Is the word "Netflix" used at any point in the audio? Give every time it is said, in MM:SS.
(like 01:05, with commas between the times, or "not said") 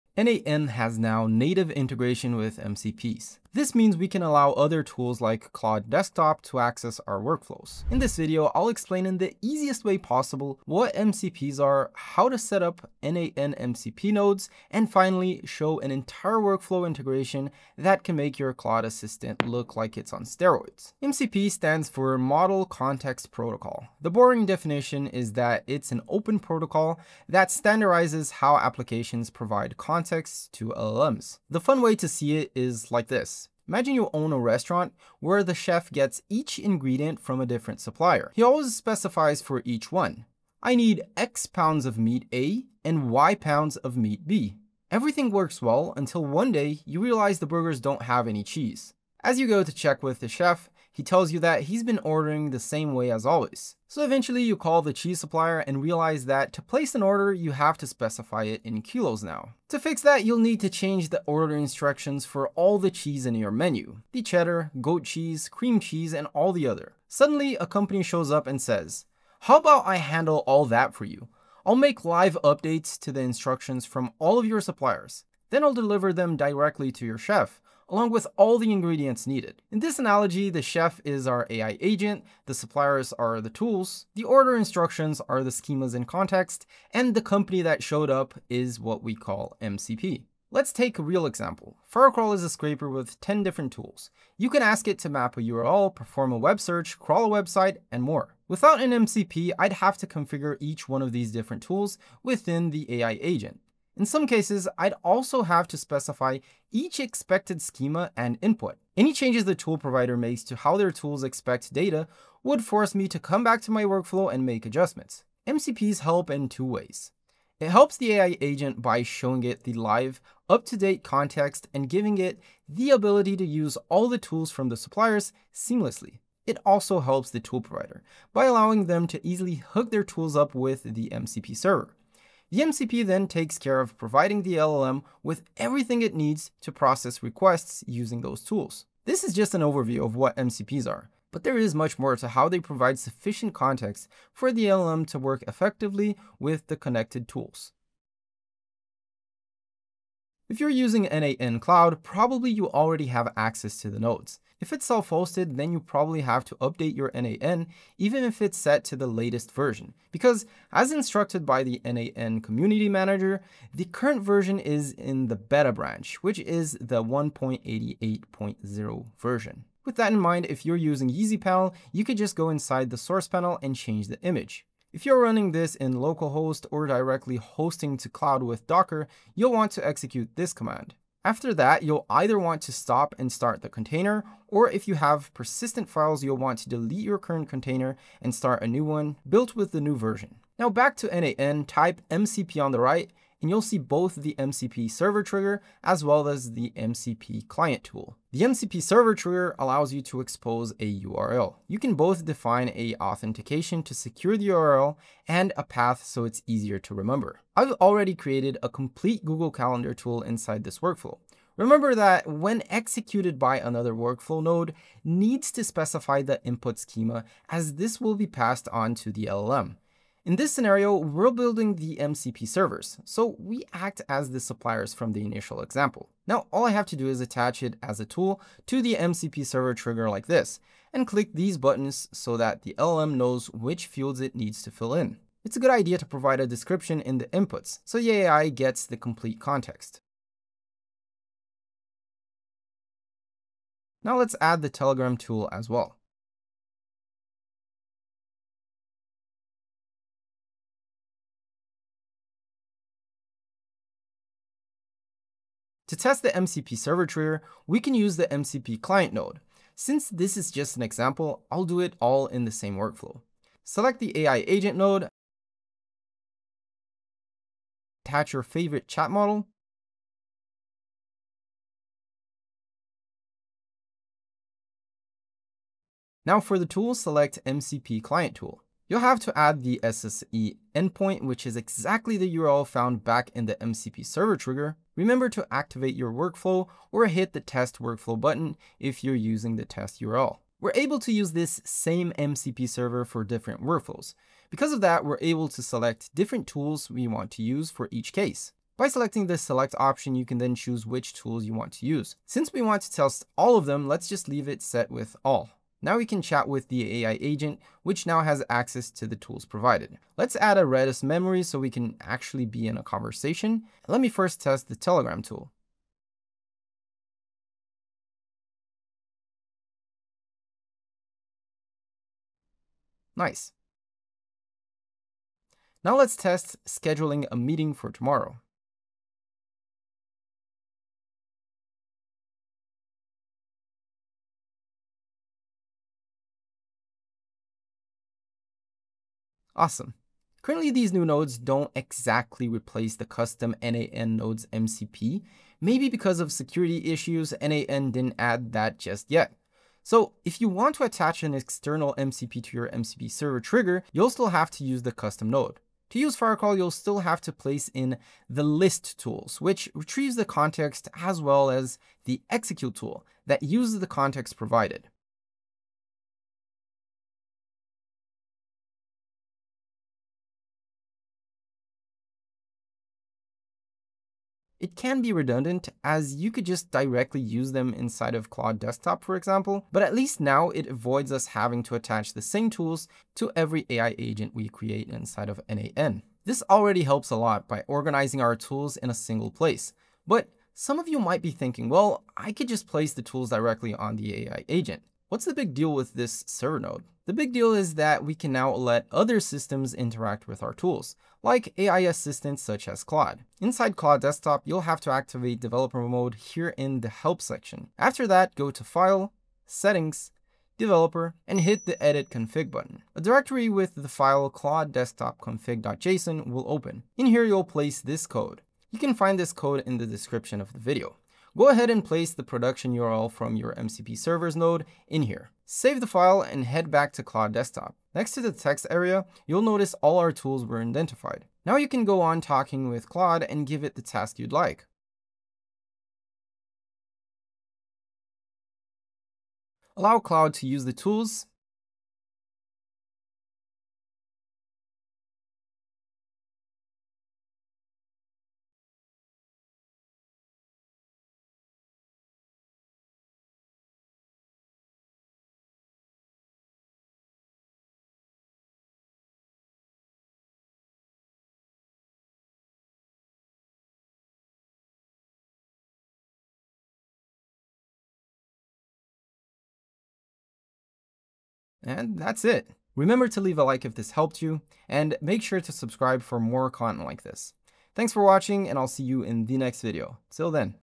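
not said.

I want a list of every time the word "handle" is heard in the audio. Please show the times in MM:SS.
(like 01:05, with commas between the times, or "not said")
01:09.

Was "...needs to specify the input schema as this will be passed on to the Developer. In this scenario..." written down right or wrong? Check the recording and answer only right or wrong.
wrong.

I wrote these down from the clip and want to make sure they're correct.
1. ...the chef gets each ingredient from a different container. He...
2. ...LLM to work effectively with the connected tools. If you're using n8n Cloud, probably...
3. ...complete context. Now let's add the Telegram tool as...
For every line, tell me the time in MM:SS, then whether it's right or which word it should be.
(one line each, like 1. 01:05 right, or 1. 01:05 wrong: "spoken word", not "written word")
1. 00:35 wrong: "supplier", not "container"
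2. 02:24 right
3. 03:58 right.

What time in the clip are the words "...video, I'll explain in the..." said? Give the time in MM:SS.
00:08.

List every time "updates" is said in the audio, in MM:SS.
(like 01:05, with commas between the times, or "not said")
01:12, 02:36.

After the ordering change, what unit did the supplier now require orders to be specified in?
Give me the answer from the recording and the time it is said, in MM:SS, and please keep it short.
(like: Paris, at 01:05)
kilos, at 00:58.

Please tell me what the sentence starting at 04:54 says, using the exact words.
Because of that, we're able to select different tools we want to use for each case.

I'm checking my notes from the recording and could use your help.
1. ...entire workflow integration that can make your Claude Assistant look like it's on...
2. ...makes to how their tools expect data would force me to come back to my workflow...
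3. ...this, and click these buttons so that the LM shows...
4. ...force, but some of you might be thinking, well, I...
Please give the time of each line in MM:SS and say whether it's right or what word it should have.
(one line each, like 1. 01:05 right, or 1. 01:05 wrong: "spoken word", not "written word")
1. 00:15 right
2. 01:50 right
3. 03:50 wrong: "knows", not "shows"
4. 06:29 wrong: "place", not "force".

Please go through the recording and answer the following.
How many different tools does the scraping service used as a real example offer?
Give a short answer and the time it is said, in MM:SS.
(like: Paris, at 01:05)
10, at 01:33.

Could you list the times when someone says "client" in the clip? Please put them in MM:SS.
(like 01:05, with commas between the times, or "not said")
03:17, 04:18, 04:38.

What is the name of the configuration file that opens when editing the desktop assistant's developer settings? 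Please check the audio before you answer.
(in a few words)
Claude Desktop Config.json.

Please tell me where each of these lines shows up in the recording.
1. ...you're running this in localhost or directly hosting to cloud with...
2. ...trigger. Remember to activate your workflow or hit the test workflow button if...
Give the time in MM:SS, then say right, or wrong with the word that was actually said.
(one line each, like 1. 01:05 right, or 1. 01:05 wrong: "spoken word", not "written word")
1. 02:55 right
2. 04:44 right.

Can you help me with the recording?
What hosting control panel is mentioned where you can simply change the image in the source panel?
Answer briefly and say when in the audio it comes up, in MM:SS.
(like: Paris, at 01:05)
Easypanel, at 02:51.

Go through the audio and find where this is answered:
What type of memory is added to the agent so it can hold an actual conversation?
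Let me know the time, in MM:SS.
05:10.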